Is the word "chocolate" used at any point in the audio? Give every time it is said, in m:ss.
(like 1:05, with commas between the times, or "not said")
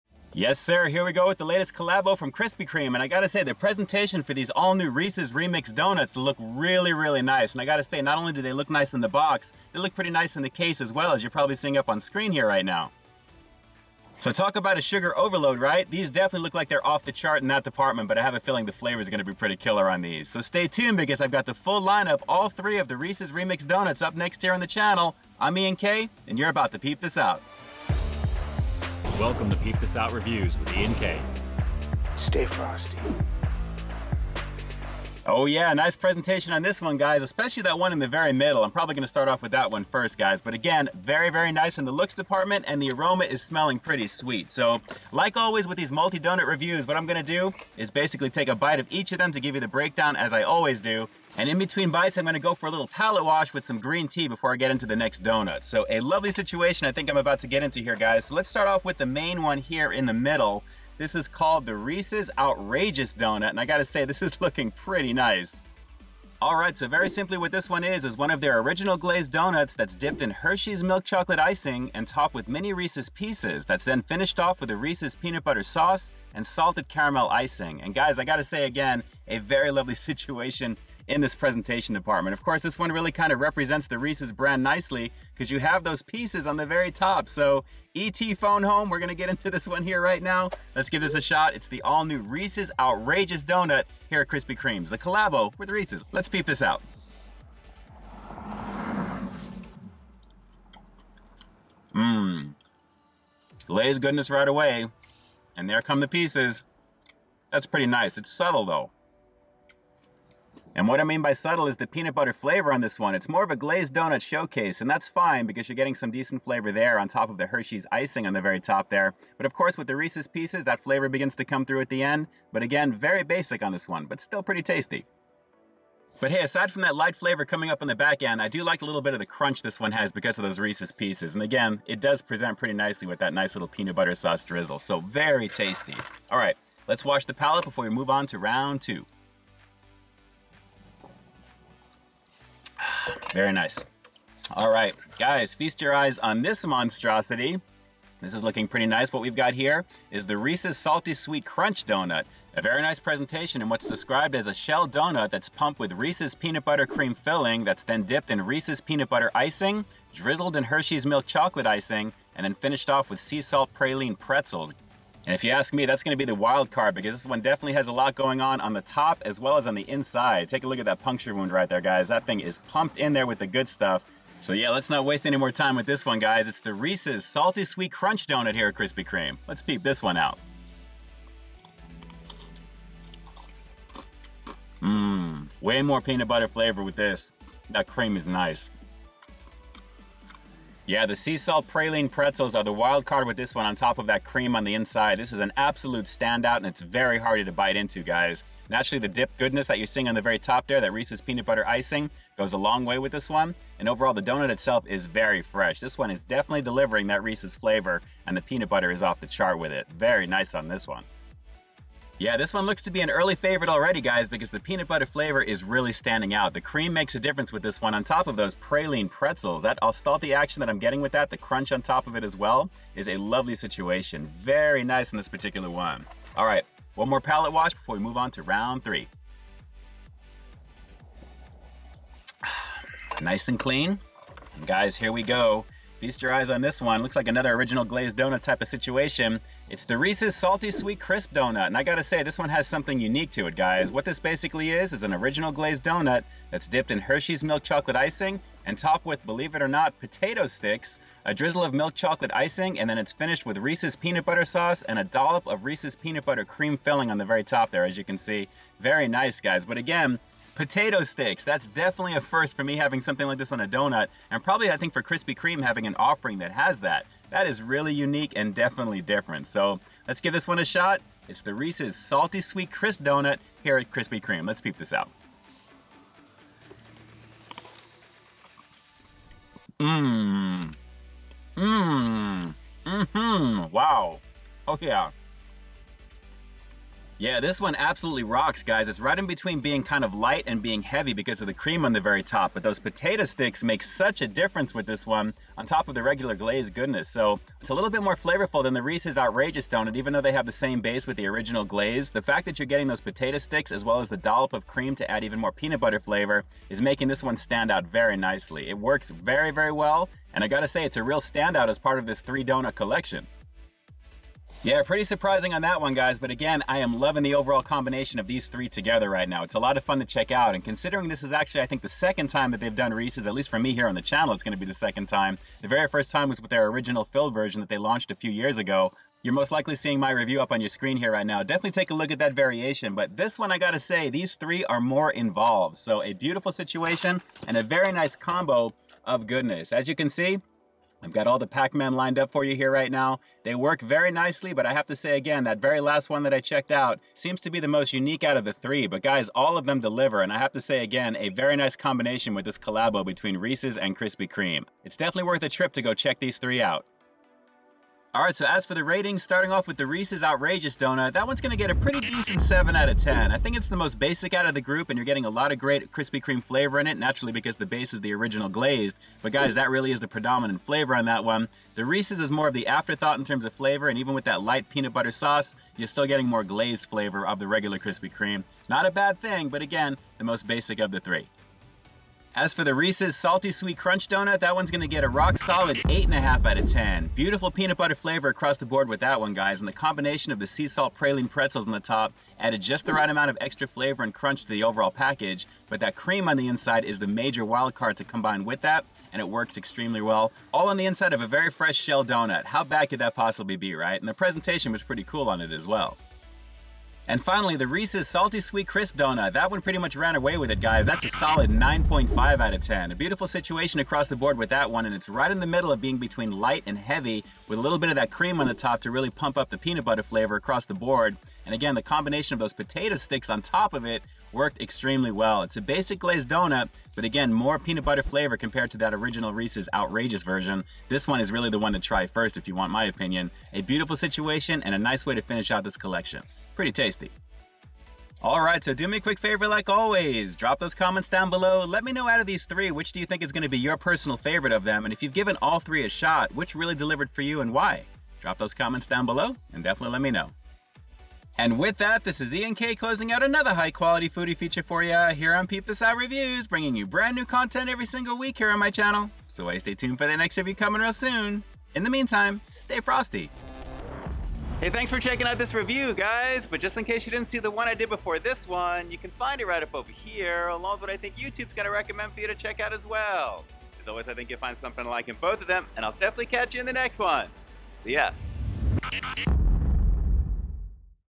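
1:11, 2:41, 4:07, 4:11.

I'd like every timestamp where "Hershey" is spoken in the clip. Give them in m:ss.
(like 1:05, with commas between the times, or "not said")
1:10, 1:57, 2:40, 4:06.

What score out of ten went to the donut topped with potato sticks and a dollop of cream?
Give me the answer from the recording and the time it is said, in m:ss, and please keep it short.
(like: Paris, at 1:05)
9.5, at 6:51.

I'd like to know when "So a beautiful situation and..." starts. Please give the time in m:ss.
5:35.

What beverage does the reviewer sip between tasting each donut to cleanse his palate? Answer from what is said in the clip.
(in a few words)
green tea.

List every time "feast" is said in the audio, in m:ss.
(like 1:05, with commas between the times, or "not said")
2:25, 3:55.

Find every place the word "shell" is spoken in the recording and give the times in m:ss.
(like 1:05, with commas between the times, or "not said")
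2:34, 6:41.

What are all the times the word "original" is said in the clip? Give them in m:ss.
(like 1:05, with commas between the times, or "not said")
1:08, 3:57, 4:05, 5:01, 5:26, 6:08, 7:08.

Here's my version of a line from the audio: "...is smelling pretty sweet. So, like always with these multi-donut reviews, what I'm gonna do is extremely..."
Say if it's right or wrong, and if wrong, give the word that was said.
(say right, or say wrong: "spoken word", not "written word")
wrong: "basically", not "extremely".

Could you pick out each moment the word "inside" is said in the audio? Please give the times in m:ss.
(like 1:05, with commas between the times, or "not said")
2:49, 3:14, 6:36, 6:40.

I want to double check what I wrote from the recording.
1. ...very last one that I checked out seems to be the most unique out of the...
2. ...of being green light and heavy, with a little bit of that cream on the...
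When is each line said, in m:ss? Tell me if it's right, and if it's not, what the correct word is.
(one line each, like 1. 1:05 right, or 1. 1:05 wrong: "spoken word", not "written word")
1. 5:45 right
2. 6:55 wrong: "between", not "green".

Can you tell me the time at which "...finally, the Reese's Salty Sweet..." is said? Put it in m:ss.
6:47.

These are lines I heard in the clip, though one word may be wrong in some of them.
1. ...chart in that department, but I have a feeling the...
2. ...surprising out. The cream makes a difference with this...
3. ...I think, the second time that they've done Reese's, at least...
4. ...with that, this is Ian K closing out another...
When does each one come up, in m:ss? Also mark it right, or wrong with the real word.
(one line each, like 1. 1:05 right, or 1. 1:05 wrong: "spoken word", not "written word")
1. 0:17 right
2. 3:35 wrong: "standing", not "surprising"
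3. 5:21 right
4. 7:31 right.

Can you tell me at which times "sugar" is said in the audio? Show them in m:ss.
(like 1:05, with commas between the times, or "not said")
0:14.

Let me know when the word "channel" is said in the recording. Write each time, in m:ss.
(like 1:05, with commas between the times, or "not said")
0:24, 5:24, 7:38.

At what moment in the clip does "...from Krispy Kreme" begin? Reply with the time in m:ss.
0:02.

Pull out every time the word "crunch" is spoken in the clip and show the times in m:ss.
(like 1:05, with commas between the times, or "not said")
2:09, 2:31, 2:57, 3:41, 6:23, 6:34.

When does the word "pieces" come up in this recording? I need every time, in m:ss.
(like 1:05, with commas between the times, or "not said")
1:13, 1:26, 1:46, 2:00, 2:10.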